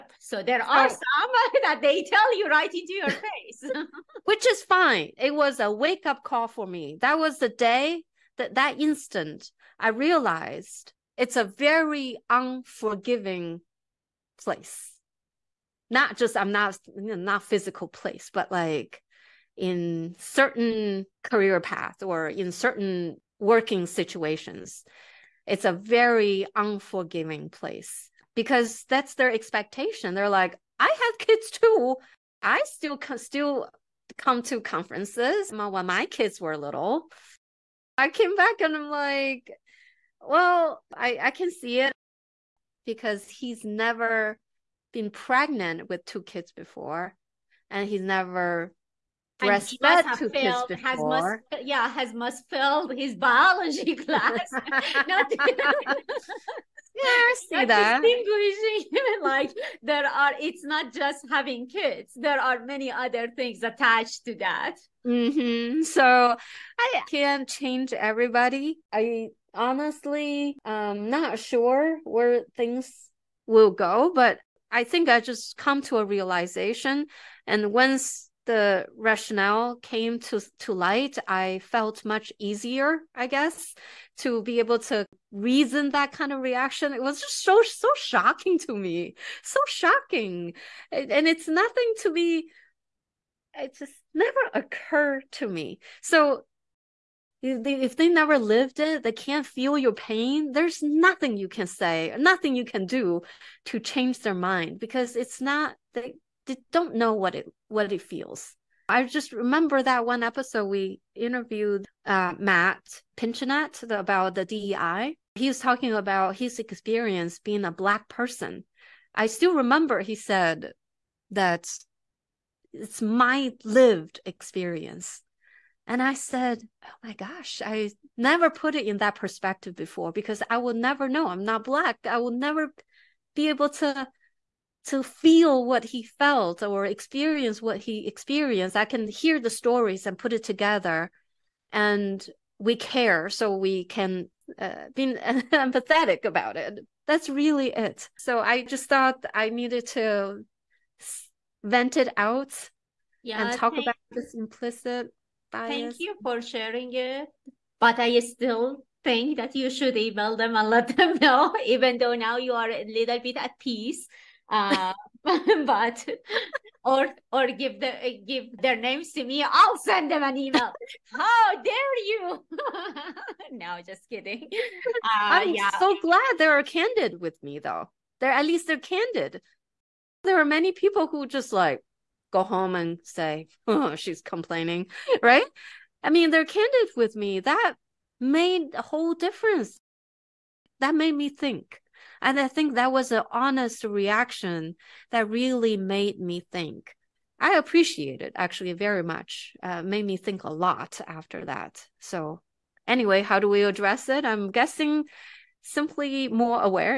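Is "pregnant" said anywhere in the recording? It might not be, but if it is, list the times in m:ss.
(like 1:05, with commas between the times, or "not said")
0:45.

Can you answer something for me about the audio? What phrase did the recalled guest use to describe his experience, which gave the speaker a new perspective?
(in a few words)
lived experience.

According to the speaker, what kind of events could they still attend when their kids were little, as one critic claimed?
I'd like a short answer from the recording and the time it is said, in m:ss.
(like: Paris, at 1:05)
conferences, at 0:34.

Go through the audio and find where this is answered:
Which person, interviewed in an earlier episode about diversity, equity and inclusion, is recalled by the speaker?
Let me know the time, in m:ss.
1:52.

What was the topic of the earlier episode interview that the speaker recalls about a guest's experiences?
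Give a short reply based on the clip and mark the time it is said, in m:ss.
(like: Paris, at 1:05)
DEI, at 1:54.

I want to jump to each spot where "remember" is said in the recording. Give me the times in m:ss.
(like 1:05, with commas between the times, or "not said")
1:49, 1:59.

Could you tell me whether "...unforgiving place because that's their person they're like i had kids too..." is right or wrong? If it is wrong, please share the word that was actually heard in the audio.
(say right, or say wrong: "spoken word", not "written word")
wrong: "expectation", not "person".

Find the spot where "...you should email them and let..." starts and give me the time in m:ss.
2:39.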